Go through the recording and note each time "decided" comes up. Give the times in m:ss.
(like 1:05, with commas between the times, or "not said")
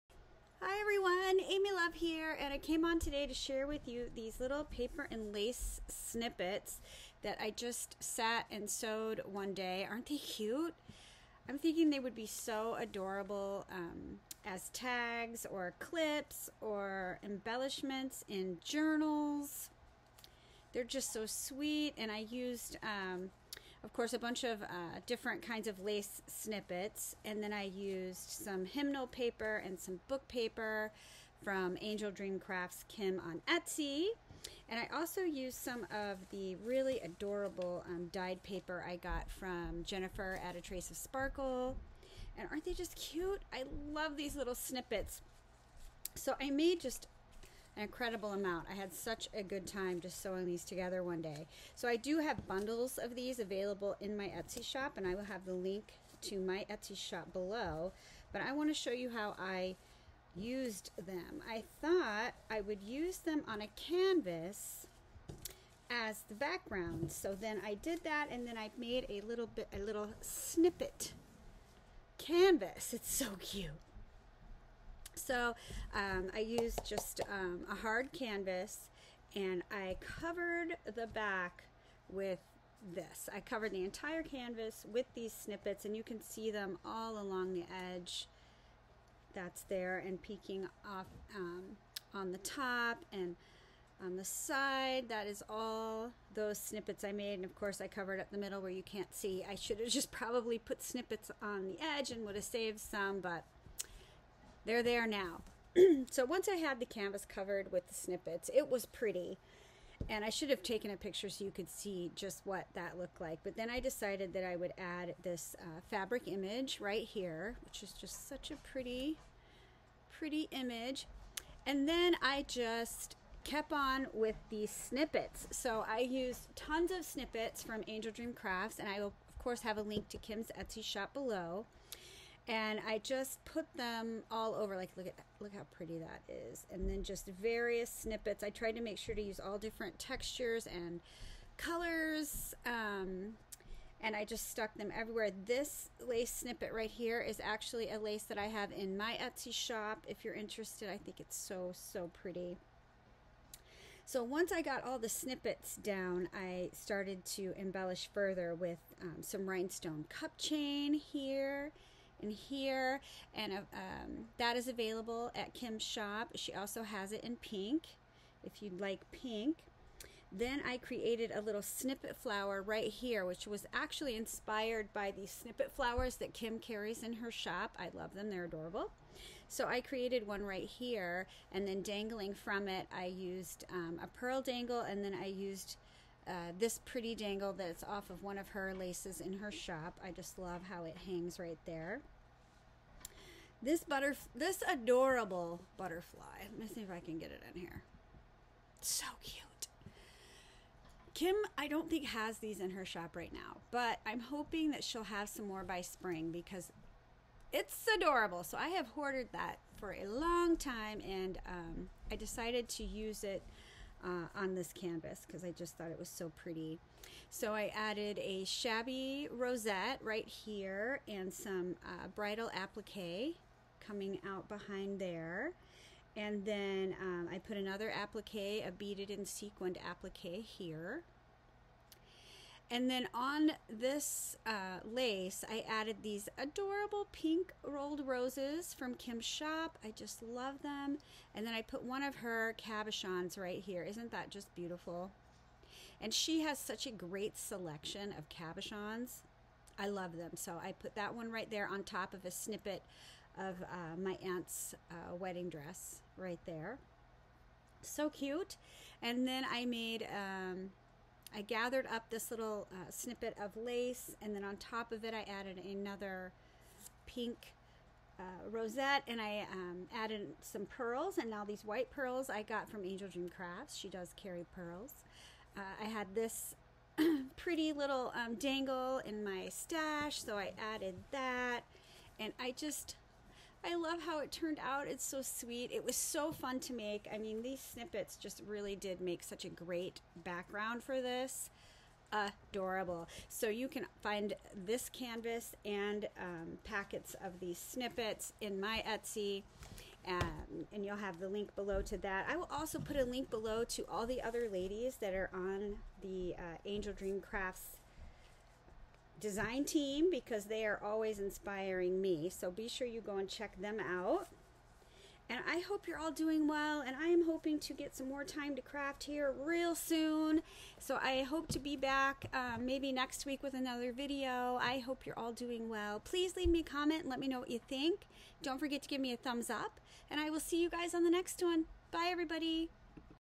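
1:53, 3:32.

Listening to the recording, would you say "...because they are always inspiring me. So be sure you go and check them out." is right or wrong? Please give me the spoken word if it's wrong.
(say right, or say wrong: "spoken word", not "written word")
right.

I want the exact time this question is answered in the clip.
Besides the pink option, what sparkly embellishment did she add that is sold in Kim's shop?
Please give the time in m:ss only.
2:39.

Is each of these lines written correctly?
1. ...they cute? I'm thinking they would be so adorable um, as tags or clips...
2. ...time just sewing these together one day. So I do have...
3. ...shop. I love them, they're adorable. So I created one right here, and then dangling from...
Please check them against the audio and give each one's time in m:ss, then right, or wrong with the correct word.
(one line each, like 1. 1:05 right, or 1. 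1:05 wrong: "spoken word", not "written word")
1. 0:10 right
2. 0:49 right
3. 2:57 right.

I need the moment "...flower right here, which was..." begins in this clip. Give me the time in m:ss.
2:52.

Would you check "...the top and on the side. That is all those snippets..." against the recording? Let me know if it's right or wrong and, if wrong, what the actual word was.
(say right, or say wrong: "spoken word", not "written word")
right.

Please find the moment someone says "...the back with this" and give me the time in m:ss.
1:20.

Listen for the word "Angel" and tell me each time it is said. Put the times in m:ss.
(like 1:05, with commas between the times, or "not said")
0:31, 2:07, 4:32, 5:06.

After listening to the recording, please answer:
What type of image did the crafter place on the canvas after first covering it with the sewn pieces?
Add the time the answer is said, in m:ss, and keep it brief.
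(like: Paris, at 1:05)
fabric image, at 1:55.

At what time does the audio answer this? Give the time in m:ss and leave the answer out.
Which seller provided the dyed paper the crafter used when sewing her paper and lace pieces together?
0:39.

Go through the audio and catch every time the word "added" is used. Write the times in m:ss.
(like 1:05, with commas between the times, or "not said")
3:37, 3:55, 4:25, 4:29, 4:40.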